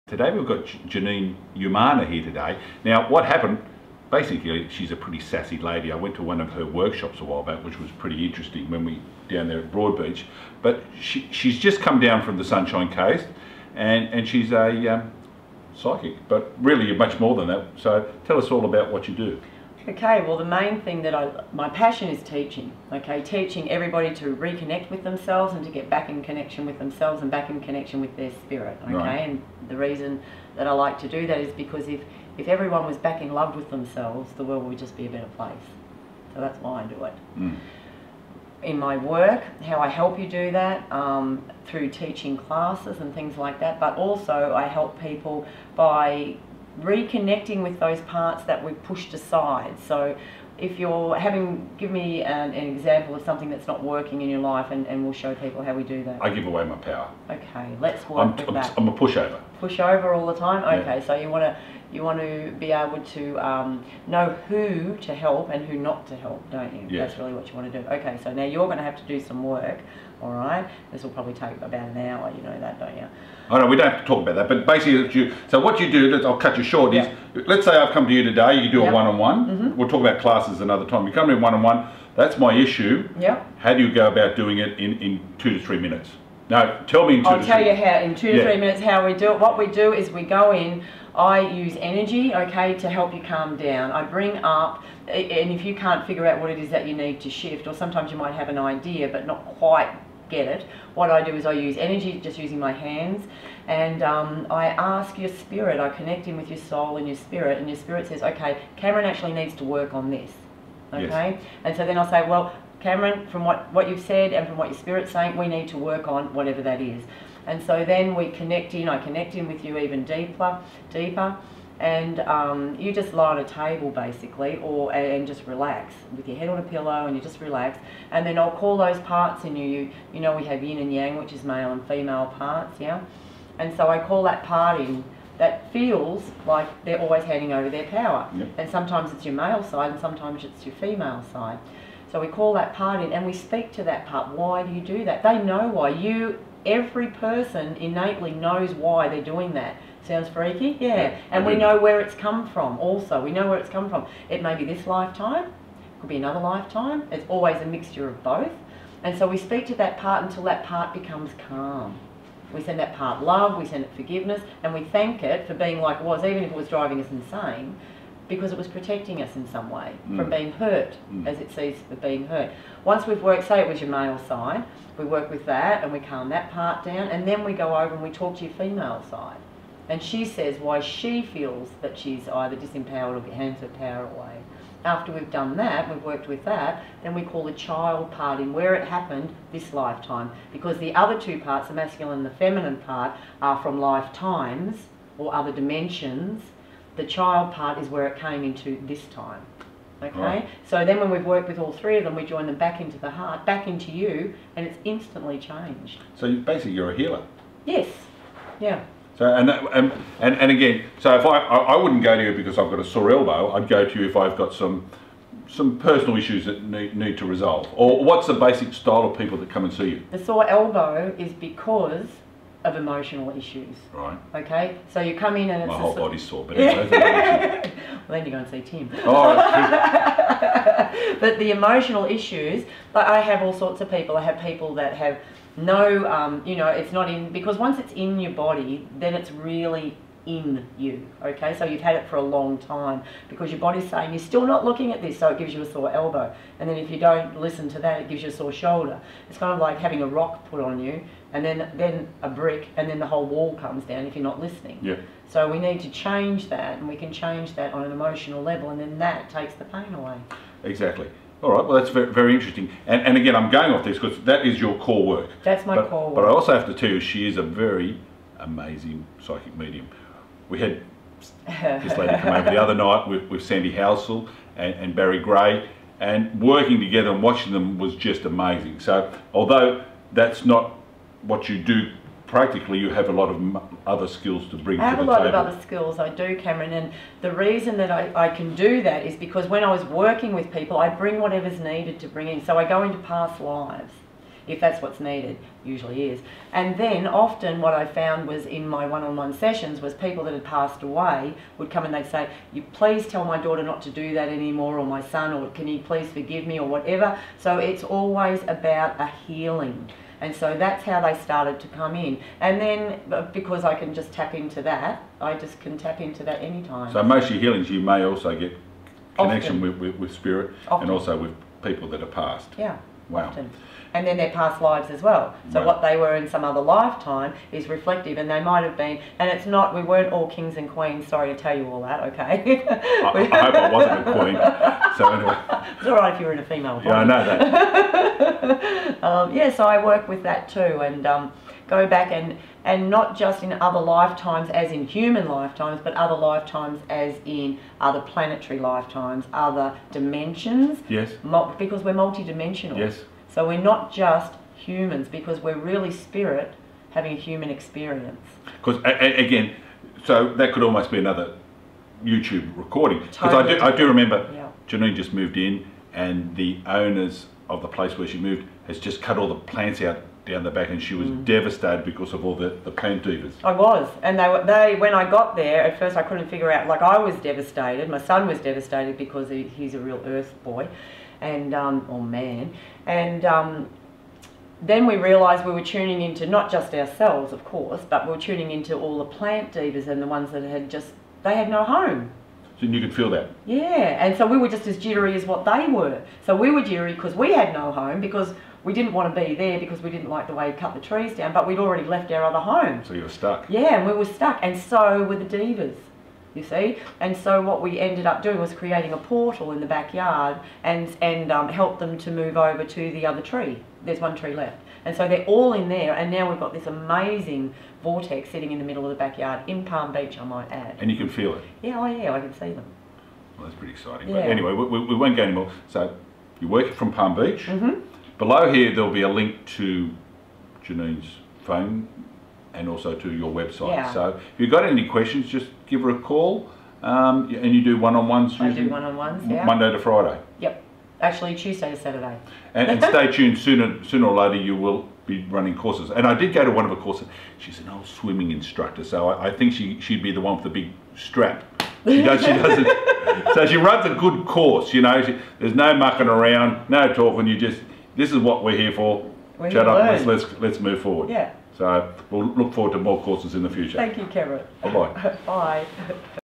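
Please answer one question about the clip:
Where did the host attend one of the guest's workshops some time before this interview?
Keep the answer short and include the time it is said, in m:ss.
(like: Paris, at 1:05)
Broadbeach, at 0:09.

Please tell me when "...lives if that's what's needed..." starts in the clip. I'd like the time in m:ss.
4:53.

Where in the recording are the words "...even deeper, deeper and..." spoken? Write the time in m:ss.
1:59.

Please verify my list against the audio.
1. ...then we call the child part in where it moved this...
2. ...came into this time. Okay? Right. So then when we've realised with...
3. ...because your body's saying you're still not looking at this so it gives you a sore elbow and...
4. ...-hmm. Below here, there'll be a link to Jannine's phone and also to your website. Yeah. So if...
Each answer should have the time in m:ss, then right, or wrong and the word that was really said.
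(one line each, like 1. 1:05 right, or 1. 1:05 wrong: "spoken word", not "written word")
1. 3:07 wrong: "happened", not "moved"
2. 3:18 wrong: "worked", not "realised"
3. 4:03 right
4. 7:07 right.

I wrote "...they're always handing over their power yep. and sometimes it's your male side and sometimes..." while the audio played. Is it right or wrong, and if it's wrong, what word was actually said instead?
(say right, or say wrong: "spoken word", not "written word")
right.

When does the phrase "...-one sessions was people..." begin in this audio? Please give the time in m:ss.
4:59.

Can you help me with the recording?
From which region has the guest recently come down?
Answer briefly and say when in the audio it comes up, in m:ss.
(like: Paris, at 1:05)
Sunshine Coast, at 0:12.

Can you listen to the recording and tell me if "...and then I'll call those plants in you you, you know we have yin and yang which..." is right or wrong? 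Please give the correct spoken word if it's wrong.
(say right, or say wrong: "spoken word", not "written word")
wrong: "parts", not "plants".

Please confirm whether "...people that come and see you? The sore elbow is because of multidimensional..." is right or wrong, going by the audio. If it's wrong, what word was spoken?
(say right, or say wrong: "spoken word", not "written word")
wrong: "emotional", not "multidimensional".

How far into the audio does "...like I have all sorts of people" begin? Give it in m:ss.
3:52.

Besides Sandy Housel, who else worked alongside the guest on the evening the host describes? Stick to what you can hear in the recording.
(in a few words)
Barry Gray.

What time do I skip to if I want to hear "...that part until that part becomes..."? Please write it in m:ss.
2:39.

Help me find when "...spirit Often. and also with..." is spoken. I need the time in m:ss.
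5:20.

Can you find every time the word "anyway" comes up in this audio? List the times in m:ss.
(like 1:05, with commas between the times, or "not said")
3:46, 5:35, 7:04.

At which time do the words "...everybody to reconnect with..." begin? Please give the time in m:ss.
0:23.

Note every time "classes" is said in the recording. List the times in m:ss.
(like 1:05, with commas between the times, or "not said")
0:42, 1:20.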